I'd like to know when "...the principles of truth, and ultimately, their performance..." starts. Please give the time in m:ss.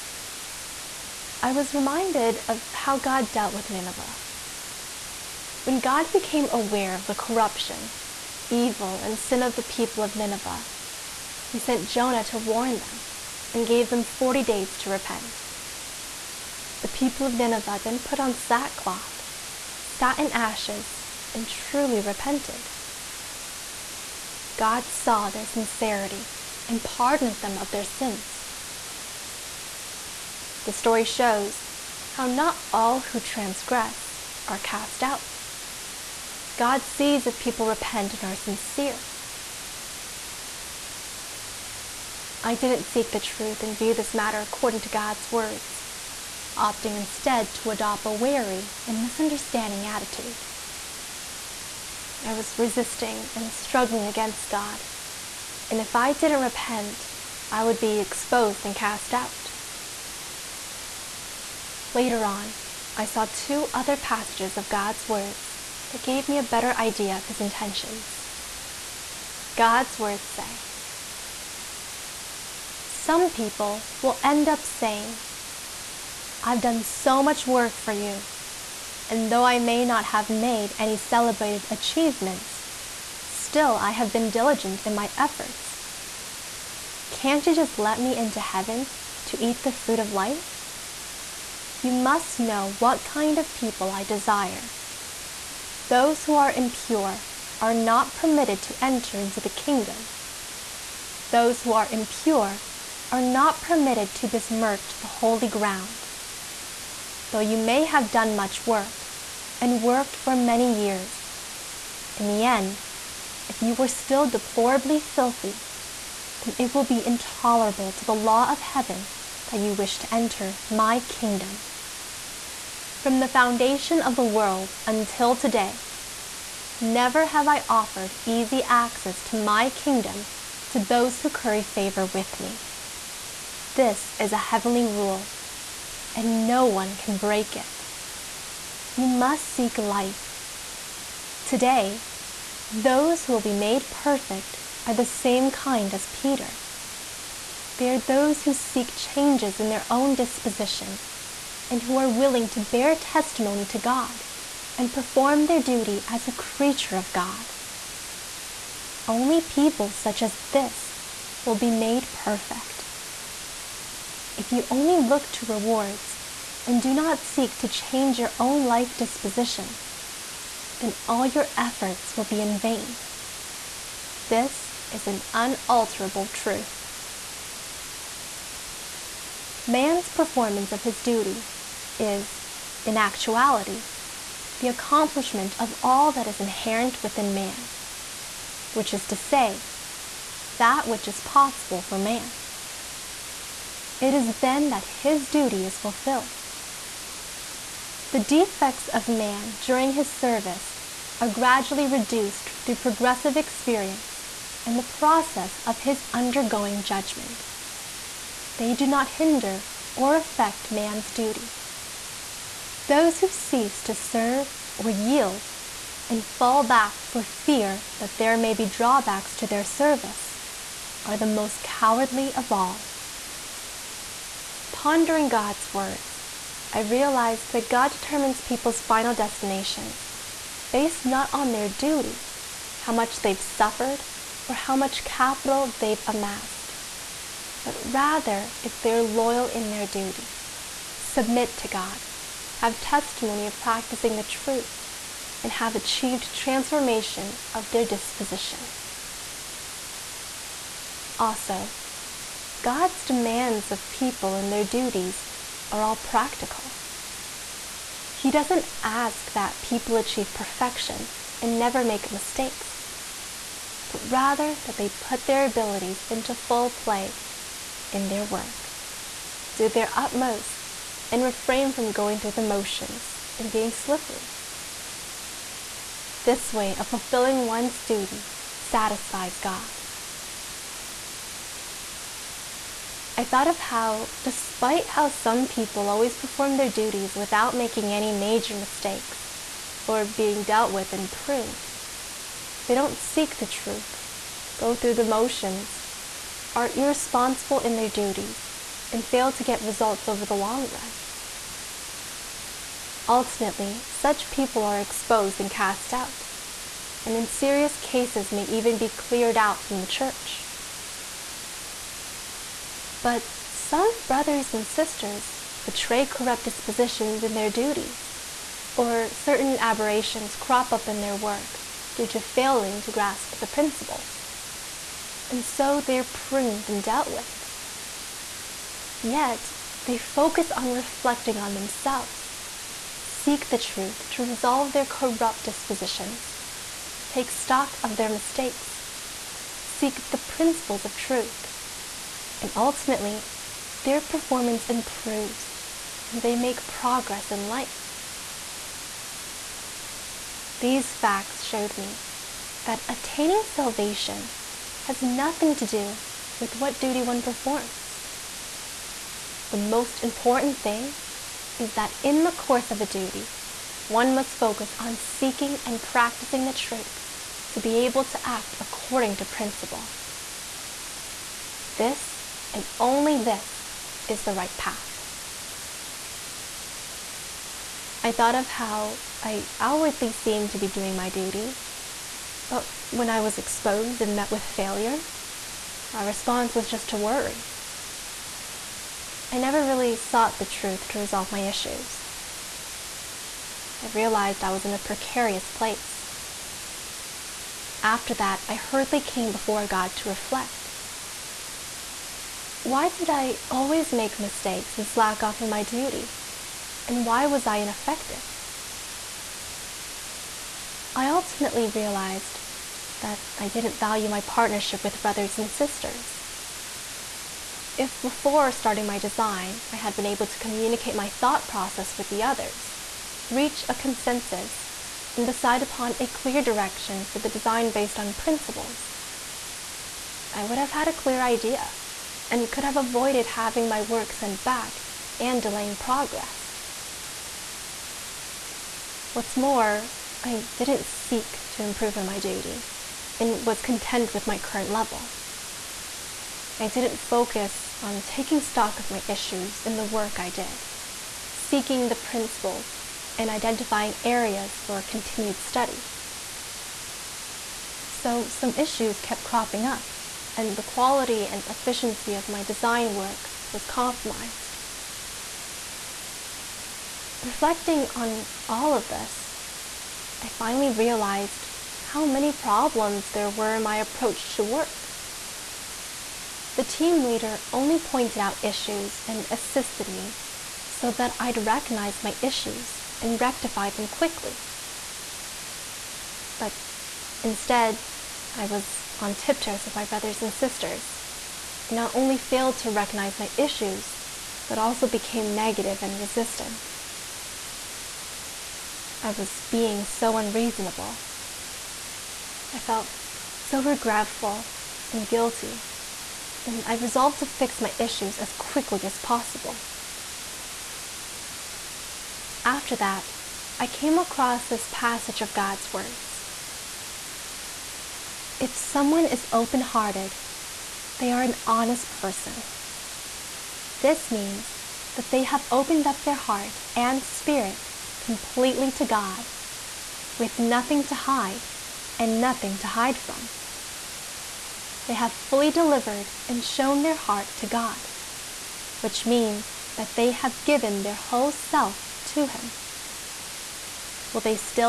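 5:40.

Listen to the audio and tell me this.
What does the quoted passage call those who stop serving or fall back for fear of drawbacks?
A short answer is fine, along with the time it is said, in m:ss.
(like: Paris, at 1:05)
most cowardly, at 3:41.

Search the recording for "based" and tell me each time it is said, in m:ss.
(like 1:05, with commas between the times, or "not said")
3:50, 7:07.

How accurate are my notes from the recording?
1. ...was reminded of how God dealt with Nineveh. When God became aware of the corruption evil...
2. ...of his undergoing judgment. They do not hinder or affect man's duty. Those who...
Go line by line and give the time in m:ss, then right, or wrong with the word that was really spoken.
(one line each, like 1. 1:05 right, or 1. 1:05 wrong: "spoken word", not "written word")
1. 0:01 right
2. 3:25 right.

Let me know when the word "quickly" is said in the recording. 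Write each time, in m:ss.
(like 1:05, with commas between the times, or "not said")
8:03, 8:28.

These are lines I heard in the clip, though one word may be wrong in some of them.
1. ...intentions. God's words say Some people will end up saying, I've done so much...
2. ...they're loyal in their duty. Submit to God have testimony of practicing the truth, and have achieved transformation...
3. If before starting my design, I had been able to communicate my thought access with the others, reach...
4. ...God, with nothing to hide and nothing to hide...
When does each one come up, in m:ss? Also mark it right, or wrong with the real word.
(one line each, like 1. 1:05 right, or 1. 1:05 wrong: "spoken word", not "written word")
1. 1:07 right
2. 3:58 right
3. 6:57 wrong: "process", not "access"
4. 8:48 right.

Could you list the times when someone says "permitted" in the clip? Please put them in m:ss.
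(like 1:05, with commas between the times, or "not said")
1:38, 1:43.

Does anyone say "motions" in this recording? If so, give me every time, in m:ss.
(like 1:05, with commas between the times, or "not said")
4:32, 4:55.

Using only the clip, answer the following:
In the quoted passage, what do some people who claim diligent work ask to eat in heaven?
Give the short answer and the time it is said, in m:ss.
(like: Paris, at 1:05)
fruit of life, at 1:29.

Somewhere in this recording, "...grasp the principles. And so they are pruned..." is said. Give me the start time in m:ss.
5:22.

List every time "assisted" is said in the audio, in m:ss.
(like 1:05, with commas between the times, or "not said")
7:59.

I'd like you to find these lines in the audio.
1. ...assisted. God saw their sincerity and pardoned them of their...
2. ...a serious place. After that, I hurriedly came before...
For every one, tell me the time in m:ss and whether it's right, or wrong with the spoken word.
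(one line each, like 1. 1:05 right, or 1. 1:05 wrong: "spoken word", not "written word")
1. 0:21 wrong: "repented", not "assisted"
2. 6:34 wrong: "precarious", not "serious".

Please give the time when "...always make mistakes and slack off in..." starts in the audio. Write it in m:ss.
6:43.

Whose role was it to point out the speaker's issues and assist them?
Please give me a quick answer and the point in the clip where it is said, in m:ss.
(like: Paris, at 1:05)
team leader, at 7:56.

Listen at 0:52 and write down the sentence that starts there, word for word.
I was resisting and struggling against God, and if I didn't repent, I would be exposed and cast out.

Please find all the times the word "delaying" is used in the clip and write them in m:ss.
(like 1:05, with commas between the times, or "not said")
7:15.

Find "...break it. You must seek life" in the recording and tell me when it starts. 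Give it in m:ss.
2:17.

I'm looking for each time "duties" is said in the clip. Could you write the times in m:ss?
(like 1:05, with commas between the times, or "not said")
4:14, 4:46, 4:57, 5:17.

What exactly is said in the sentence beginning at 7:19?
What's more, I didn't seek to improve in my duty and was content with my current level.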